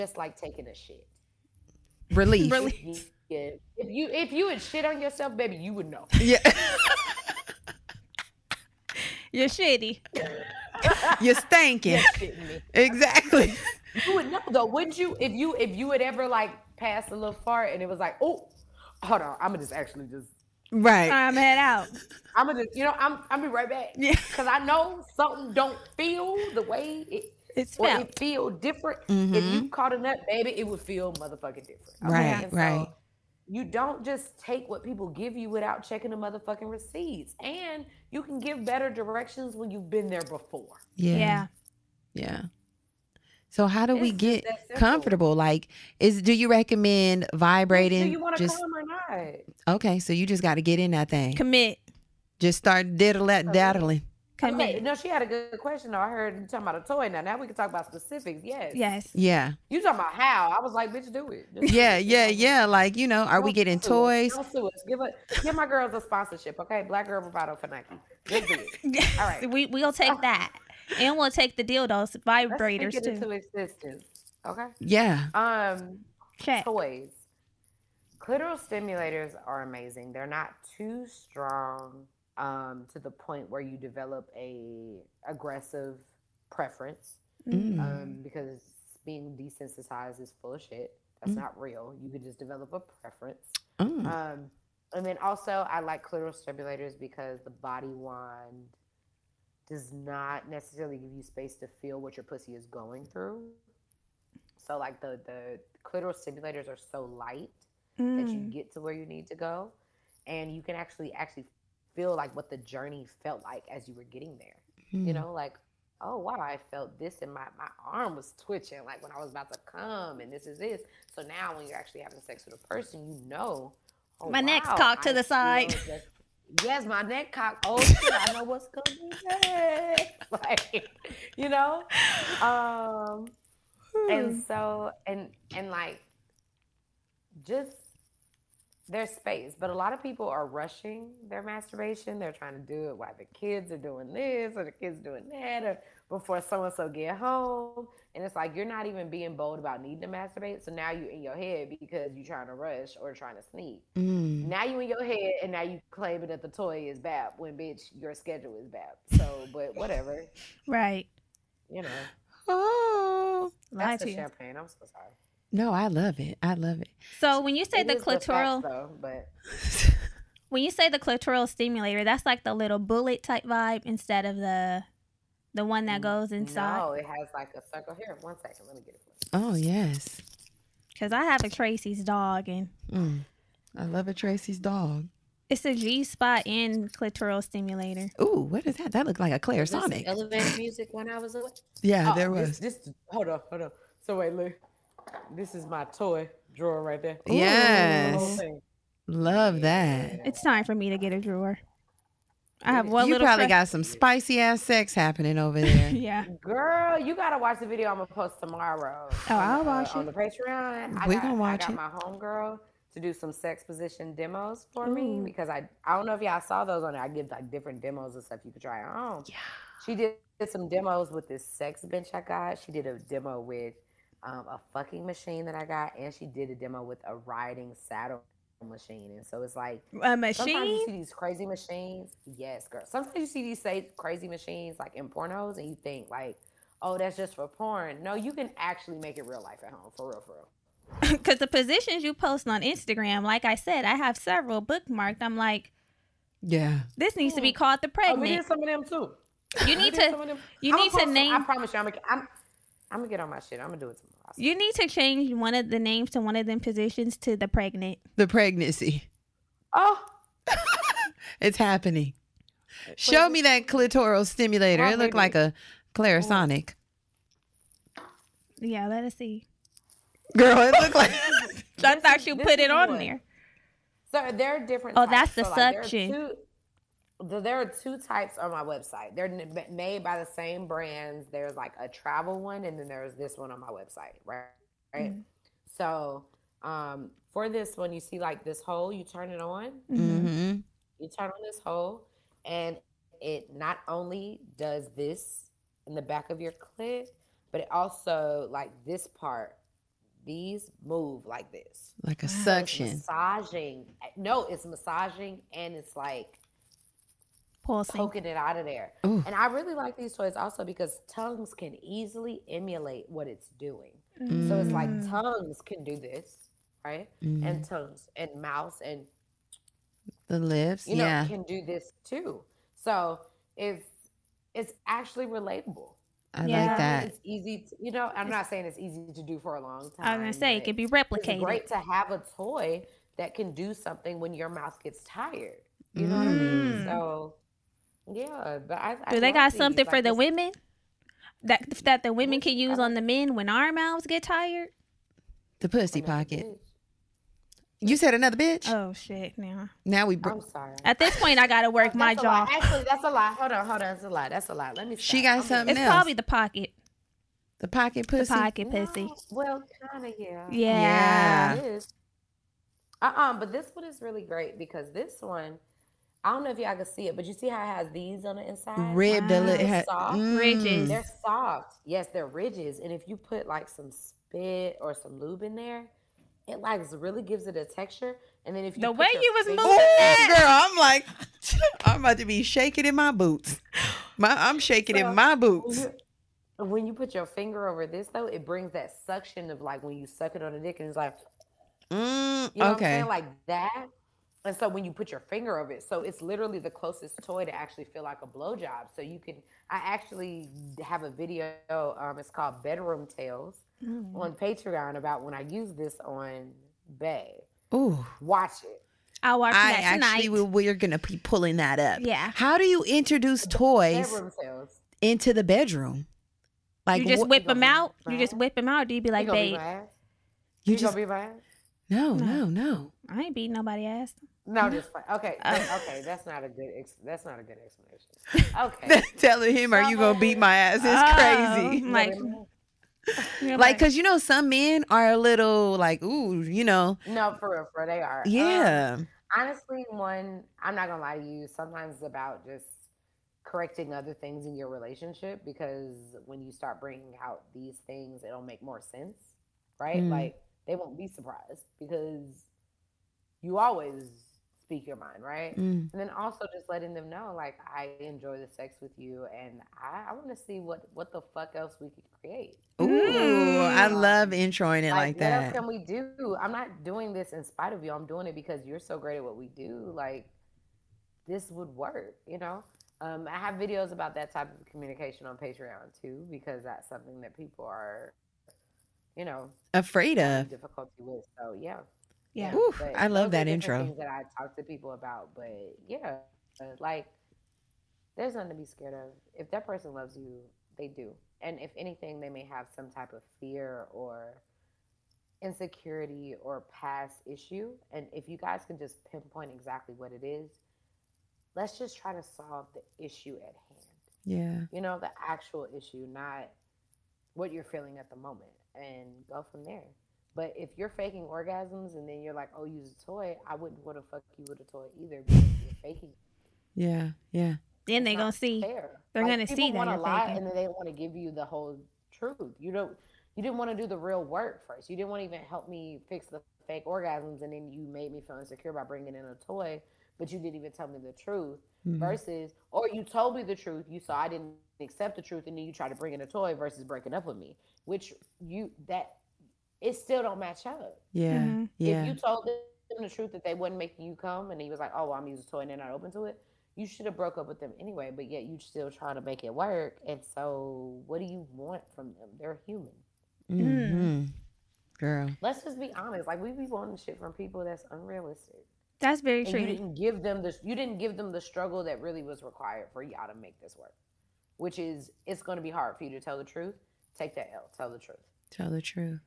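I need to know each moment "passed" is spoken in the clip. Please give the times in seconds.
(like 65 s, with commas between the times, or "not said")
16 s.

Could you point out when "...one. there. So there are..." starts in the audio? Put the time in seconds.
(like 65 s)
272 s.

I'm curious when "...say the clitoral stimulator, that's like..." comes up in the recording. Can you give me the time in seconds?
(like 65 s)
170 s.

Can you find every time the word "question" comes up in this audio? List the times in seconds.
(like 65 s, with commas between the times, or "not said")
55 s.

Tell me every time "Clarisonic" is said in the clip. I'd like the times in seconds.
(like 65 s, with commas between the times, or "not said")
189 s, 265 s.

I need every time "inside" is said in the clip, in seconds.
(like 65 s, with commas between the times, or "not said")
176 s, 368 s.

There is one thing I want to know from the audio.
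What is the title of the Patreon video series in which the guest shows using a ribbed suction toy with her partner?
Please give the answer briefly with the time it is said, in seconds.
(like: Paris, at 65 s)
Bedroom Tales, at 402 s.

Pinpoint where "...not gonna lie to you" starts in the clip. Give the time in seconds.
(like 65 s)
440 s.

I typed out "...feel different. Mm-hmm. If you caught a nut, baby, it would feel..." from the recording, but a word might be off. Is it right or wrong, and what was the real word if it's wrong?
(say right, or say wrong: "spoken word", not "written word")
right.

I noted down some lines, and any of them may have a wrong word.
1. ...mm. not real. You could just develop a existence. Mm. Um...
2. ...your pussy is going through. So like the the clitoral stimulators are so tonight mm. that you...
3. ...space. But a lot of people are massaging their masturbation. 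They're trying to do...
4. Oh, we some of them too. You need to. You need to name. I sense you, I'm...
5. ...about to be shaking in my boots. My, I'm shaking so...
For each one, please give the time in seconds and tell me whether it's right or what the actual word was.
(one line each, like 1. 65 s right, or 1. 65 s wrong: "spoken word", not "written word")
1. 91 s wrong: "preference", not "existence"
2. 102 s wrong: "light", not "tonight"
3. 139 s wrong: "rushing", not "massaging"
4. 248 s wrong: "promise", not "sense"
5. 382 s right.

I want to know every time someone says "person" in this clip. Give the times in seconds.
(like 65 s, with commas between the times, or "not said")
122 s, 489 s.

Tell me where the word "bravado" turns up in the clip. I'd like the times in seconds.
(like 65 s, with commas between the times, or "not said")
67 s.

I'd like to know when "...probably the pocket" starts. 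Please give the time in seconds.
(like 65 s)
355 s.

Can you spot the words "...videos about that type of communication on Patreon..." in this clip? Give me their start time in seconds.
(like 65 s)
473 s.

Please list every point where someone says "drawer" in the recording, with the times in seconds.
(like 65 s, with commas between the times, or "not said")
196 s, 201 s.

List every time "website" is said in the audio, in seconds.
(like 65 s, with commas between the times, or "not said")
278 s, 283 s.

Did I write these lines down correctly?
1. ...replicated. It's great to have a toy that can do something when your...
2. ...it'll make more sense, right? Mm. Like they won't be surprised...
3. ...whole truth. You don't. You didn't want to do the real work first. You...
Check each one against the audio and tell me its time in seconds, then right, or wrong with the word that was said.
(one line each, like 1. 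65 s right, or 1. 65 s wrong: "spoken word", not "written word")
1. 330 s right
2. 448 s right
3. 521 s right.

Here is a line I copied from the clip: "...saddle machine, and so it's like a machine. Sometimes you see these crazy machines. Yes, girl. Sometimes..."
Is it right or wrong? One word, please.
right.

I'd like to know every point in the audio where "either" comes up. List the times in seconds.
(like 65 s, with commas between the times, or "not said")
514 s.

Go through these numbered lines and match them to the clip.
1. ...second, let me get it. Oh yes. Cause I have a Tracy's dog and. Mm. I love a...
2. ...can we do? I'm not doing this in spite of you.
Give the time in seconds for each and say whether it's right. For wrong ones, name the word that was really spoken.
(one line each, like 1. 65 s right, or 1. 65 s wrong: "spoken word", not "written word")
1. 178 s right
2. 465 s right.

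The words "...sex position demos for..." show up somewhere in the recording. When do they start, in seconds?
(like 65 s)
213 s.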